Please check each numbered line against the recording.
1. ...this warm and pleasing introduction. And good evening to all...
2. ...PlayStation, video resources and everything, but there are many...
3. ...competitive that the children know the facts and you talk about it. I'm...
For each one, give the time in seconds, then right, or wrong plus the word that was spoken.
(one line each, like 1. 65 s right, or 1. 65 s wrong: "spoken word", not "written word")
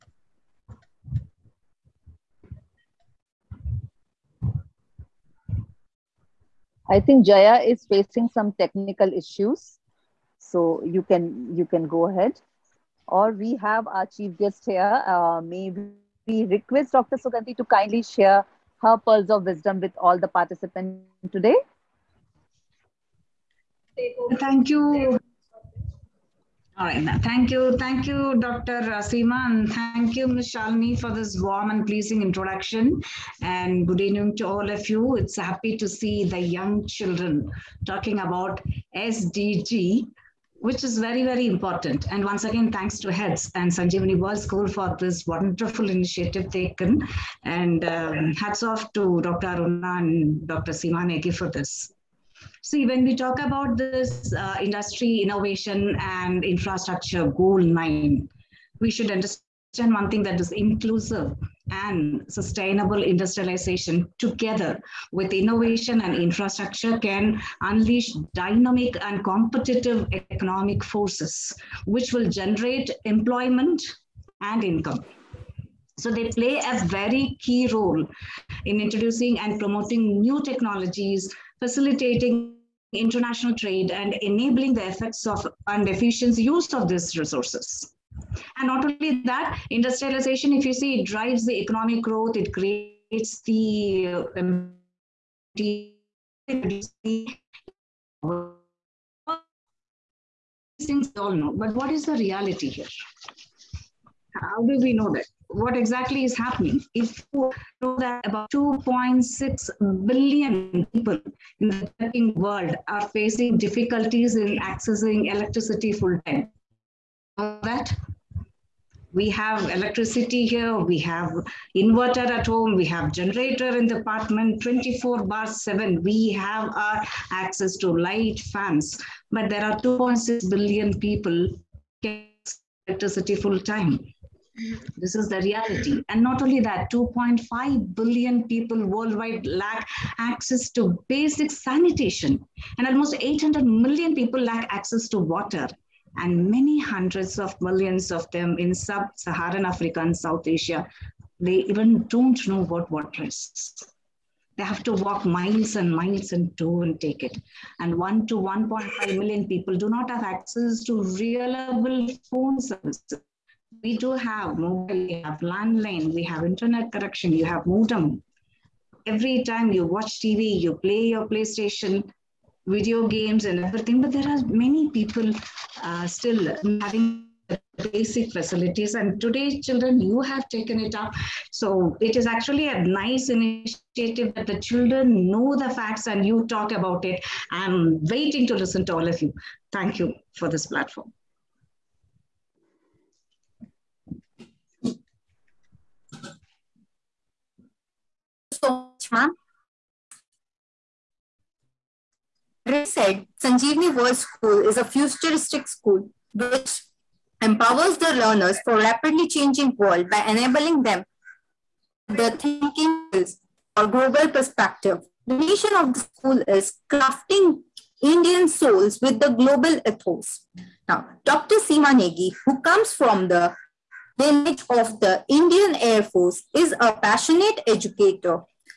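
1. 31 s right
2. 171 s wrong: "games", not "resources"
3. 183 s wrong: "initiative", not "competitive".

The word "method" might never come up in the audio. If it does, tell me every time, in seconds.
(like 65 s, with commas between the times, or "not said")
not said.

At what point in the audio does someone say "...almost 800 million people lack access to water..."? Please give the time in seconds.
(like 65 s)
142 s.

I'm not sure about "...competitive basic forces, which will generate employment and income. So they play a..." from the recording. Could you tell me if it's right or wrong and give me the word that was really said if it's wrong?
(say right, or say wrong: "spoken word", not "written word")
wrong: "economic", not "basic".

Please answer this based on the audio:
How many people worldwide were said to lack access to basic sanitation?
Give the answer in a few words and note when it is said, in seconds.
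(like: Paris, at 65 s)
2.5 billion, at 136 s.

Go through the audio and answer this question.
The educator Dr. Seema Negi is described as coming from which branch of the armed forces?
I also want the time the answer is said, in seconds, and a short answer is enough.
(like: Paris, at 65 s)
Indian Air Force, at 225 s.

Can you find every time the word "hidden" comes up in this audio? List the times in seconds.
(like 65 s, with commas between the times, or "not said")
not said.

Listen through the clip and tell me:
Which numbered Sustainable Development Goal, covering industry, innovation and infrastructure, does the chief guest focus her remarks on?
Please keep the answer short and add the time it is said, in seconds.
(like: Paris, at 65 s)
Goal 9, at 57 s.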